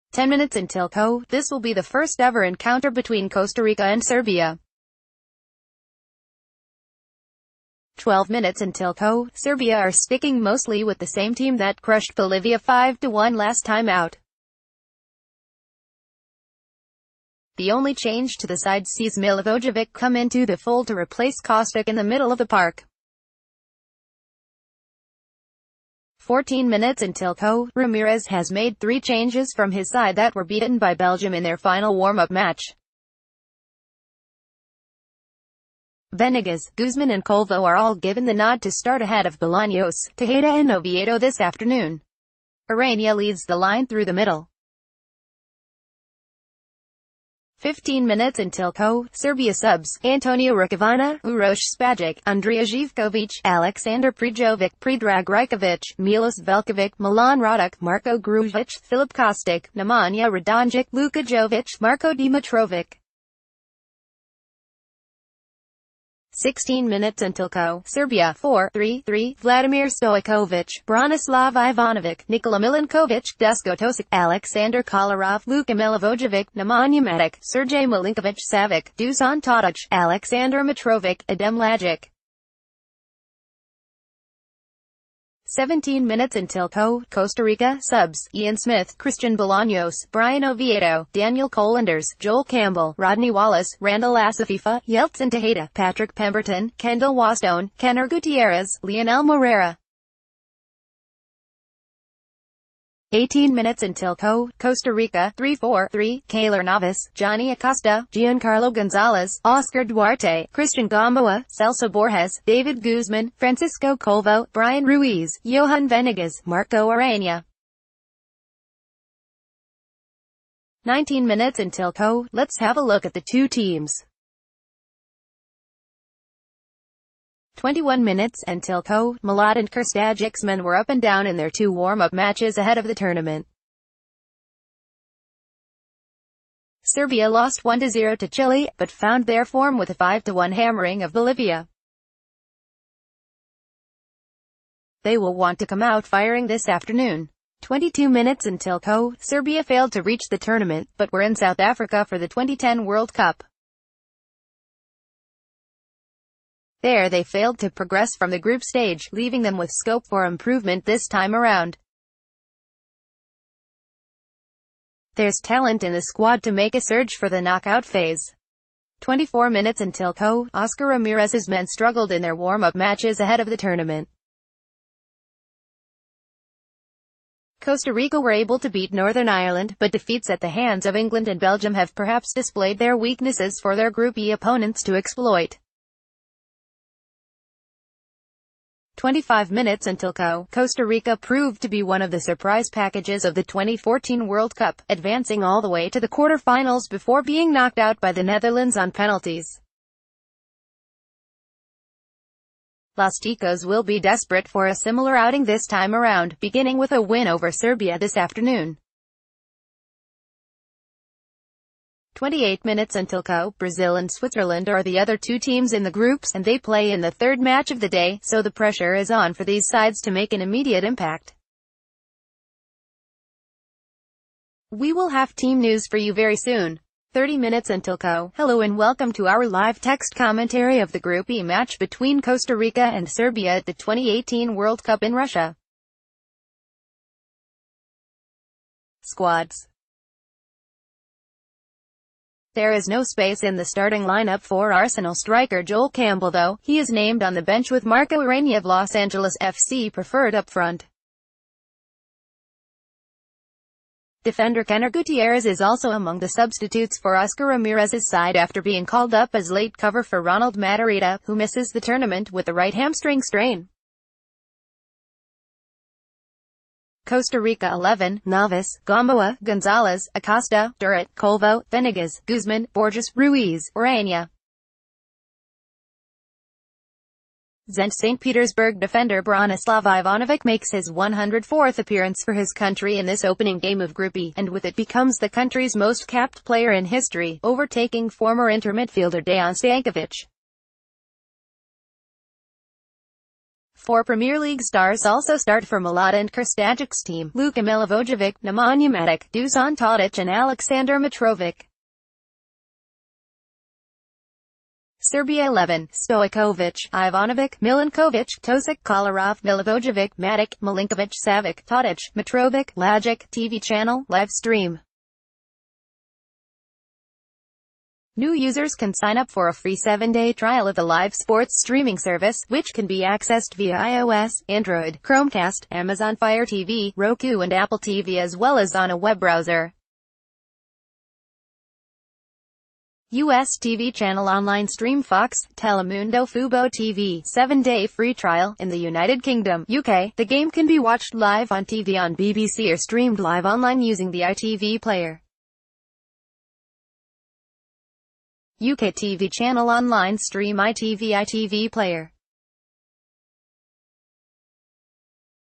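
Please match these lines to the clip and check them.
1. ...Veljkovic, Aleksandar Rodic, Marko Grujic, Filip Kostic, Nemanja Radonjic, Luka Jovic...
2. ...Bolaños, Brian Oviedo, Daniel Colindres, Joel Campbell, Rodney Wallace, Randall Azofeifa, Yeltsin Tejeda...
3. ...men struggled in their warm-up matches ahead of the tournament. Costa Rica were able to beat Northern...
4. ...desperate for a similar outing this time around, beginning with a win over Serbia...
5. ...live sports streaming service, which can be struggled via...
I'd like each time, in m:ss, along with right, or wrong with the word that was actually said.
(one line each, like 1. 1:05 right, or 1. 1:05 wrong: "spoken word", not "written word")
1. 0:56 wrong: "Milan", not "Aleksandar"
2. 1:29 right
3. 2:51 right
4. 3:23 right
5. 5:20 wrong: "accessed", not "struggled".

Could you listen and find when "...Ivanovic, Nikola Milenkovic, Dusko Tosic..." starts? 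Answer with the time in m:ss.
1:11.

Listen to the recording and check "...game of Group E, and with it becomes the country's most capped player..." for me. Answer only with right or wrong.
right.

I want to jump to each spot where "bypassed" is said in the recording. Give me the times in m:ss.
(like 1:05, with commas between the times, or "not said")
not said.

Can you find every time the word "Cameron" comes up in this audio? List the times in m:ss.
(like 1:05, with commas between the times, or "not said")
not said.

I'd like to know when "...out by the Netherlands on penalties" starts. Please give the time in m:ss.
3:17.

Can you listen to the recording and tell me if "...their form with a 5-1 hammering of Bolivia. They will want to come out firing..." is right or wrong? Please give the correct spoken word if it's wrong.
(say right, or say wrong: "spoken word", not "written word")
right.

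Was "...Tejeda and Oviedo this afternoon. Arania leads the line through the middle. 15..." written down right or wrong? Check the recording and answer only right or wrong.
right.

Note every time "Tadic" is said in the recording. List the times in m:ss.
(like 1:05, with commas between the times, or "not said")
1:19, 4:59, 5:11.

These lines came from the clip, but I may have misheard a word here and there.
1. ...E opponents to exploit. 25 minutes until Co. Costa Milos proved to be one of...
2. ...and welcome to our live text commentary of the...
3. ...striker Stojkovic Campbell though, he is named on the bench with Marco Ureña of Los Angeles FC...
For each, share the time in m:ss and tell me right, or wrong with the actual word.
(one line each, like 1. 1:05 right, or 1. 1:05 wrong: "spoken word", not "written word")
1. 3:04 wrong: "Rica", not "Milos"
2. 3:48 right
3. 4:05 wrong: "Joel", not "Stojkovic".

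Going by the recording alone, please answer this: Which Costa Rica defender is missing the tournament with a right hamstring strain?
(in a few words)
Ronald Matarita.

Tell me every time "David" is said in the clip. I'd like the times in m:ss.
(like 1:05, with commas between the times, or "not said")
1:52.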